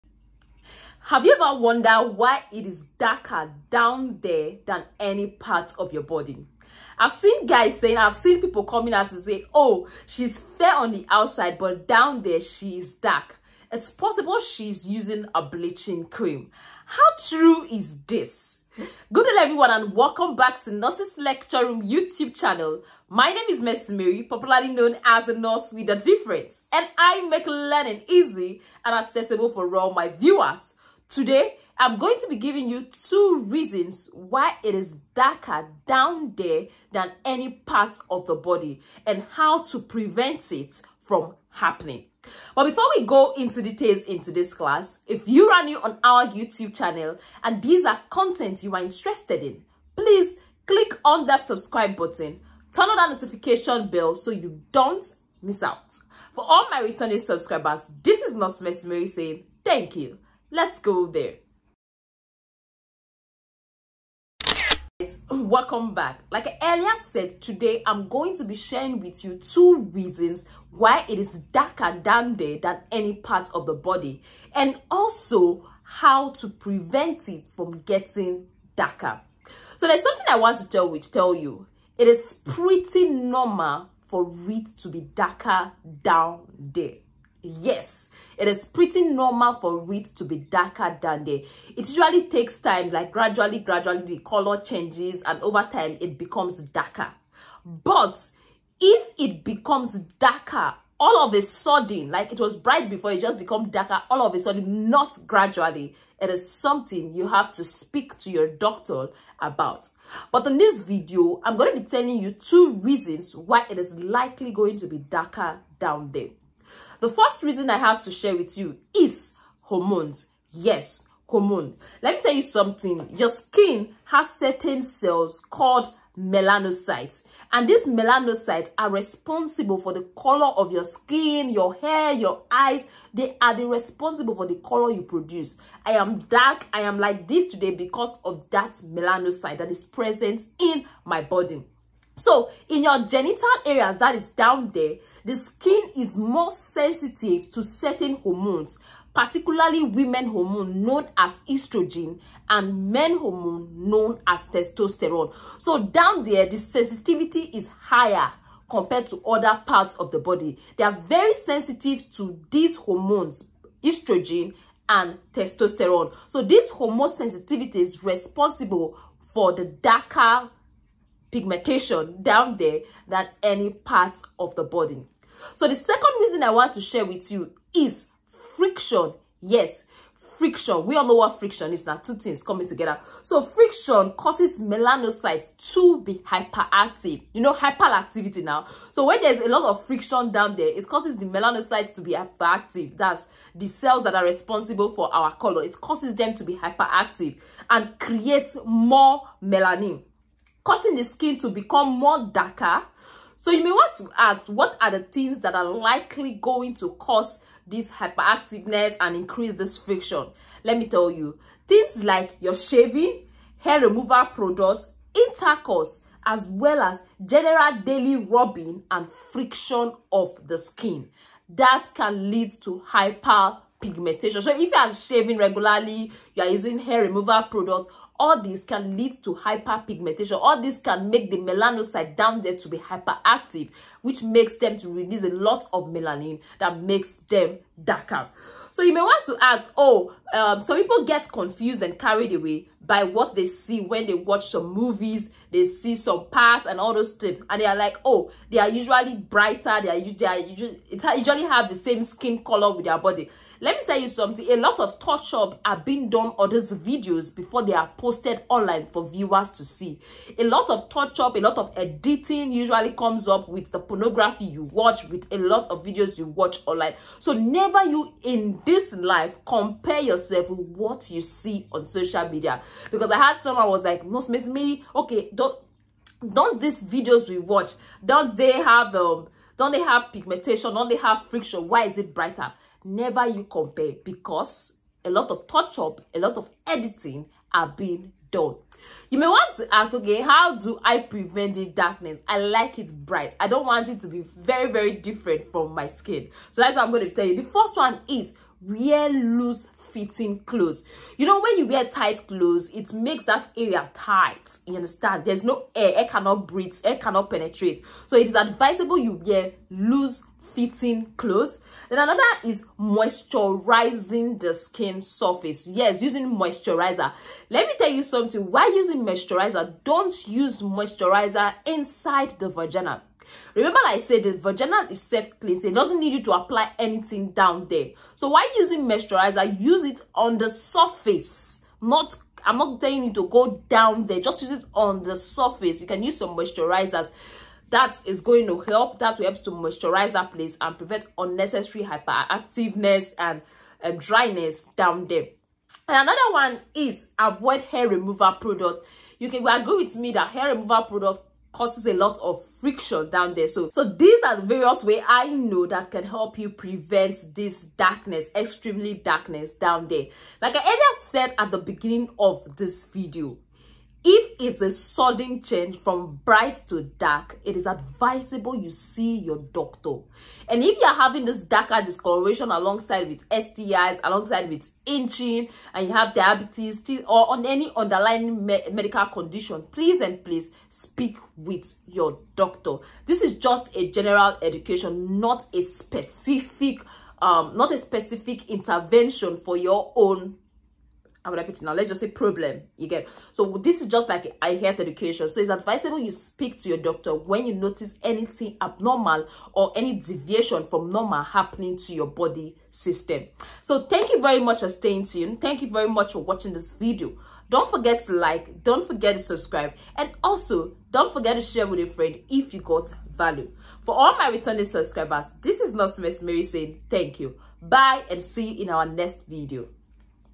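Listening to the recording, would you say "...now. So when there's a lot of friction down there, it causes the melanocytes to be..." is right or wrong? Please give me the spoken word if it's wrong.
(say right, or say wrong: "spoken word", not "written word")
right.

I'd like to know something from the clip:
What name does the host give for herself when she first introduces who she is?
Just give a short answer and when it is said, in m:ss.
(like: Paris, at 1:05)
Messi Mary, at 0:23.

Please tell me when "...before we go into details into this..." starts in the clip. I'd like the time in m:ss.
0:42.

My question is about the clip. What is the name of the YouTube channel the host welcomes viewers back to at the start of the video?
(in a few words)
Nurses Lecture Room.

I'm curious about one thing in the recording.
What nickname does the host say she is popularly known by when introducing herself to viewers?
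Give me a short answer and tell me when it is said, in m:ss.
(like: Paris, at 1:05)
the nurse with a difference, at 0:25.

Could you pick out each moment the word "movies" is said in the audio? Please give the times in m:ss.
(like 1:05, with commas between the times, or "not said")
4:04.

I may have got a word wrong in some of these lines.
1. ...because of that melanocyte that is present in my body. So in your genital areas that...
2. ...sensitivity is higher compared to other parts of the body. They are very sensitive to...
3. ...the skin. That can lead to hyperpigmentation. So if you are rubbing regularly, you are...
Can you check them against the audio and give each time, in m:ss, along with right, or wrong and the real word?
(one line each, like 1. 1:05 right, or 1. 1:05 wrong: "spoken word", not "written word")
1. 2:17 right
2. 2:36 right
3. 3:40 wrong: "shaving", not "rubbing".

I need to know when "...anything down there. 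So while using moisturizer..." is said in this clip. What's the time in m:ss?
5:26.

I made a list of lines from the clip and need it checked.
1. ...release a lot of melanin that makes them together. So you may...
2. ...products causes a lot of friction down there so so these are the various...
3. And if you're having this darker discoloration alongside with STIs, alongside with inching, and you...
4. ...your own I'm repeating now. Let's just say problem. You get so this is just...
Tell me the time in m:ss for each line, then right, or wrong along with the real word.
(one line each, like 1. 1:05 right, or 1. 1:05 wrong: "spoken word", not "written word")
1. 3:54 wrong: "darker", not "together"
2. 5:50 right
3. 6:10 right
4. 6:29 right.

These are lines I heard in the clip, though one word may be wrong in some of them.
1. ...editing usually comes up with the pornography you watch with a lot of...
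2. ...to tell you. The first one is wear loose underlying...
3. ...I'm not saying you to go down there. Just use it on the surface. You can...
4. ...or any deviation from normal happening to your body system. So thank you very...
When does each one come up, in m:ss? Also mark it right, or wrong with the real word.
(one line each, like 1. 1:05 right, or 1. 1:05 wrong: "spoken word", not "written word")
1. 4:21 right
2. 4:57 wrong: "fitting", not "underlying"
3. 5:32 wrong: "telling", not "saying"
4. 6:39 right.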